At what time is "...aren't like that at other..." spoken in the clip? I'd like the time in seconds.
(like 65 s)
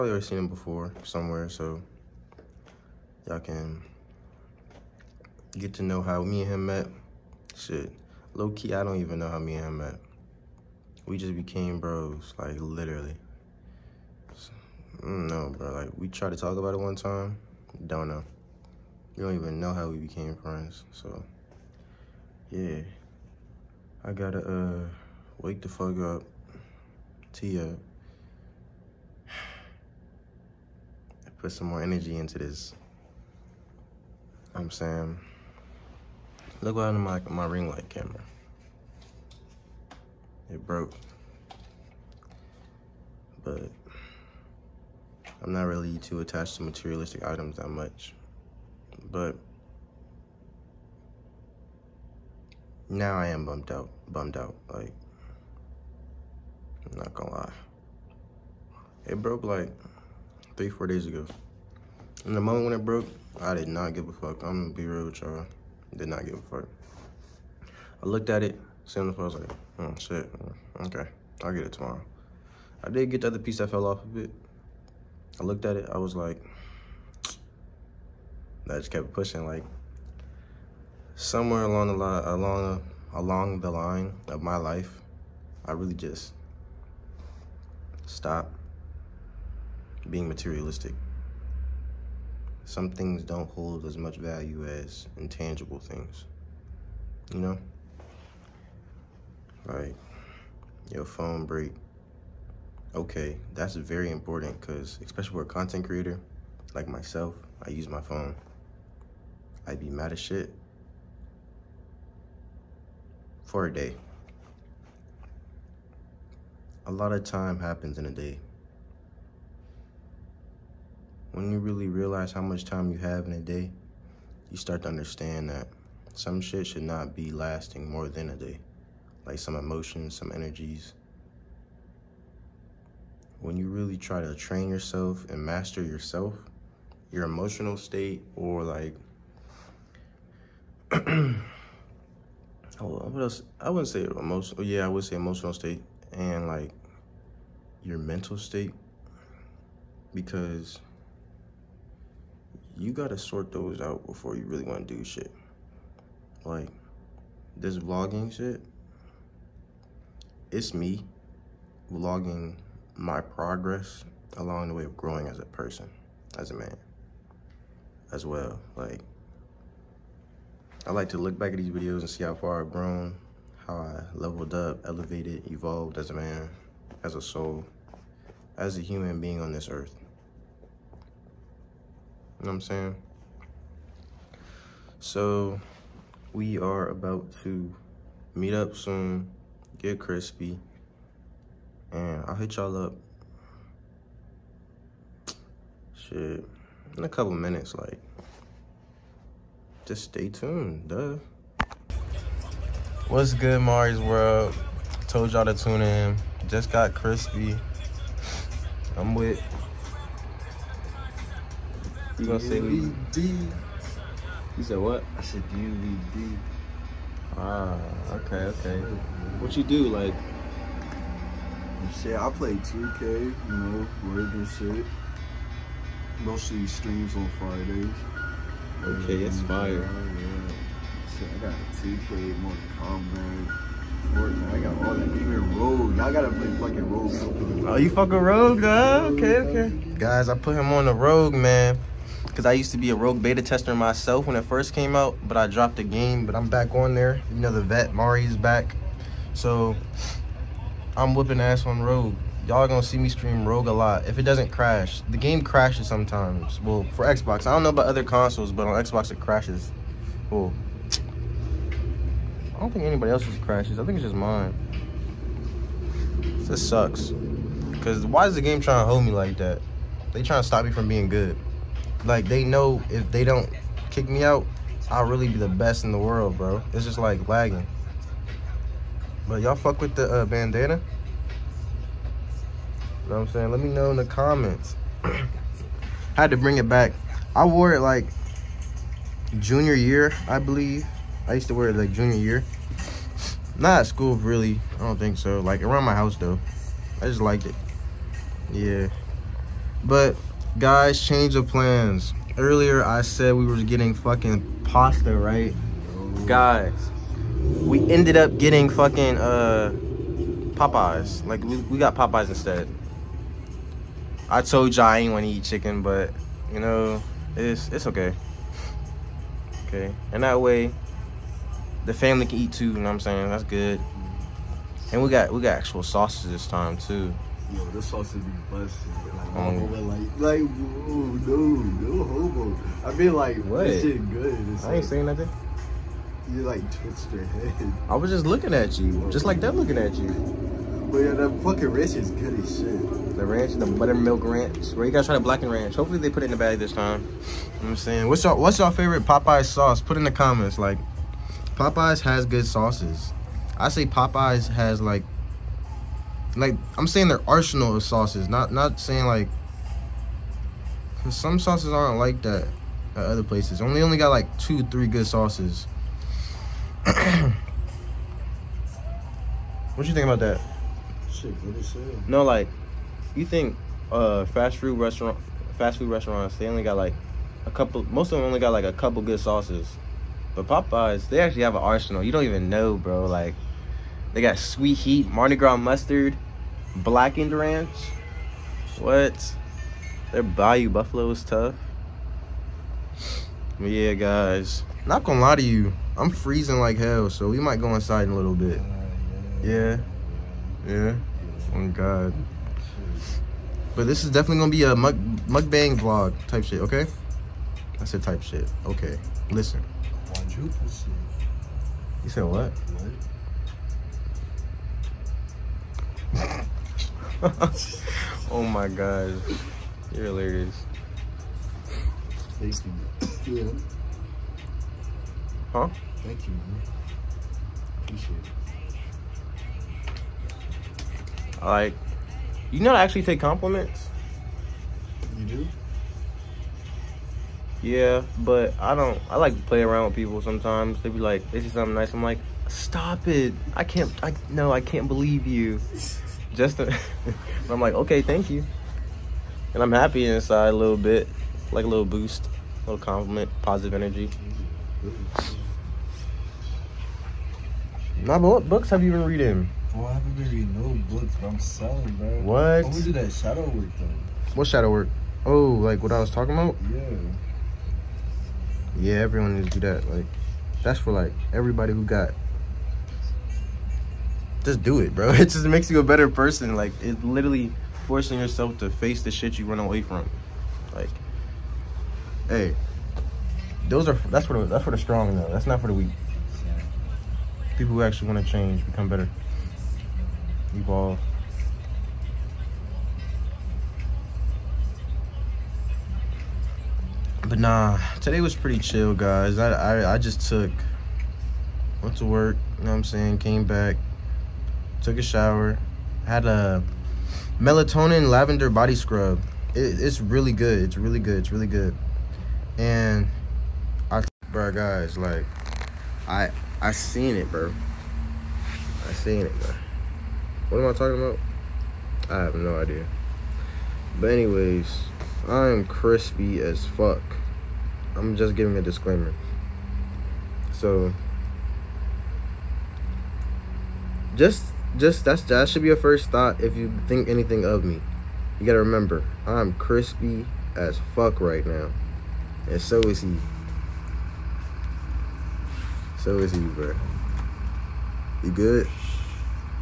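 361 s.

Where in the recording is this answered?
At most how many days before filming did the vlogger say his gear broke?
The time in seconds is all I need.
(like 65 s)
60 s.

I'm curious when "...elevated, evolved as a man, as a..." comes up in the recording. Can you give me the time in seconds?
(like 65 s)
174 s.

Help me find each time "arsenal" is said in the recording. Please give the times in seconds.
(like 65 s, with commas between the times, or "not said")
357 s, 381 s.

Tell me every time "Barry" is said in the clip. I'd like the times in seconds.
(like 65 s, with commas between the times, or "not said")
not said.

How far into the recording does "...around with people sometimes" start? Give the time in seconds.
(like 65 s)
439 s.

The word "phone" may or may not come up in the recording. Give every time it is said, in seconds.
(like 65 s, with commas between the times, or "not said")
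101 s, 108 s.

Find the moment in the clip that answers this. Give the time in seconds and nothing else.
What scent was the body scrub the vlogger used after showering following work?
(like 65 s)
507 s.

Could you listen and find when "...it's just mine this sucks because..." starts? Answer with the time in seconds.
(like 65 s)
263 s.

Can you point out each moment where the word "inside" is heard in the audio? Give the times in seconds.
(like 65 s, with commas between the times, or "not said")
397 s, 450 s.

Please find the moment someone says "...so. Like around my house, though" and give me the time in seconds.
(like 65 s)
295 s.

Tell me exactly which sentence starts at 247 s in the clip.
You know the vet, Mari's back.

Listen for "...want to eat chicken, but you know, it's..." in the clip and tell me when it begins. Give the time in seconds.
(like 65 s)
315 s.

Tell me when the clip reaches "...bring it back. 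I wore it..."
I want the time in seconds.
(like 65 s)
286 s.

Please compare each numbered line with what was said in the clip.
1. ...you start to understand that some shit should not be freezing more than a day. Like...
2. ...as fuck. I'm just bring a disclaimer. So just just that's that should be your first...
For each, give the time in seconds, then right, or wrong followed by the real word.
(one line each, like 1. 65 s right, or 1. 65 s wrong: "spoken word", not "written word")
1. 124 s wrong: "lasting", not "freezing"
2. 526 s wrong: "giving", not "bring".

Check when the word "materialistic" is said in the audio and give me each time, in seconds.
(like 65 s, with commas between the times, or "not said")
46 s, 90 s.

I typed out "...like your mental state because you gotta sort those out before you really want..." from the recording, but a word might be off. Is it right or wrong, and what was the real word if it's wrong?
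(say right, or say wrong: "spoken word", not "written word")
right.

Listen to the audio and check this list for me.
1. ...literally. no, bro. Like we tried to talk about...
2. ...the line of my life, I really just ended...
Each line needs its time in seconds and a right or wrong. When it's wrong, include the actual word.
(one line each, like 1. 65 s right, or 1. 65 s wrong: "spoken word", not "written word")
1. 12 s right
2. 83 s wrong: "stopped", not "ended".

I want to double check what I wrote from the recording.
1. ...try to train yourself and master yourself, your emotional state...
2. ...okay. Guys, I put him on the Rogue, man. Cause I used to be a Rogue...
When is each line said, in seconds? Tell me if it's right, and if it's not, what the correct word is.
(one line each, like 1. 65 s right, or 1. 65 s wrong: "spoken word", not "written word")
1. 133 s right
2. 239 s right.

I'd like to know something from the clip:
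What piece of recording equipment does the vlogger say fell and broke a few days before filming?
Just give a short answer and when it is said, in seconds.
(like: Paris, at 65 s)
Ring light camera, at 37 s.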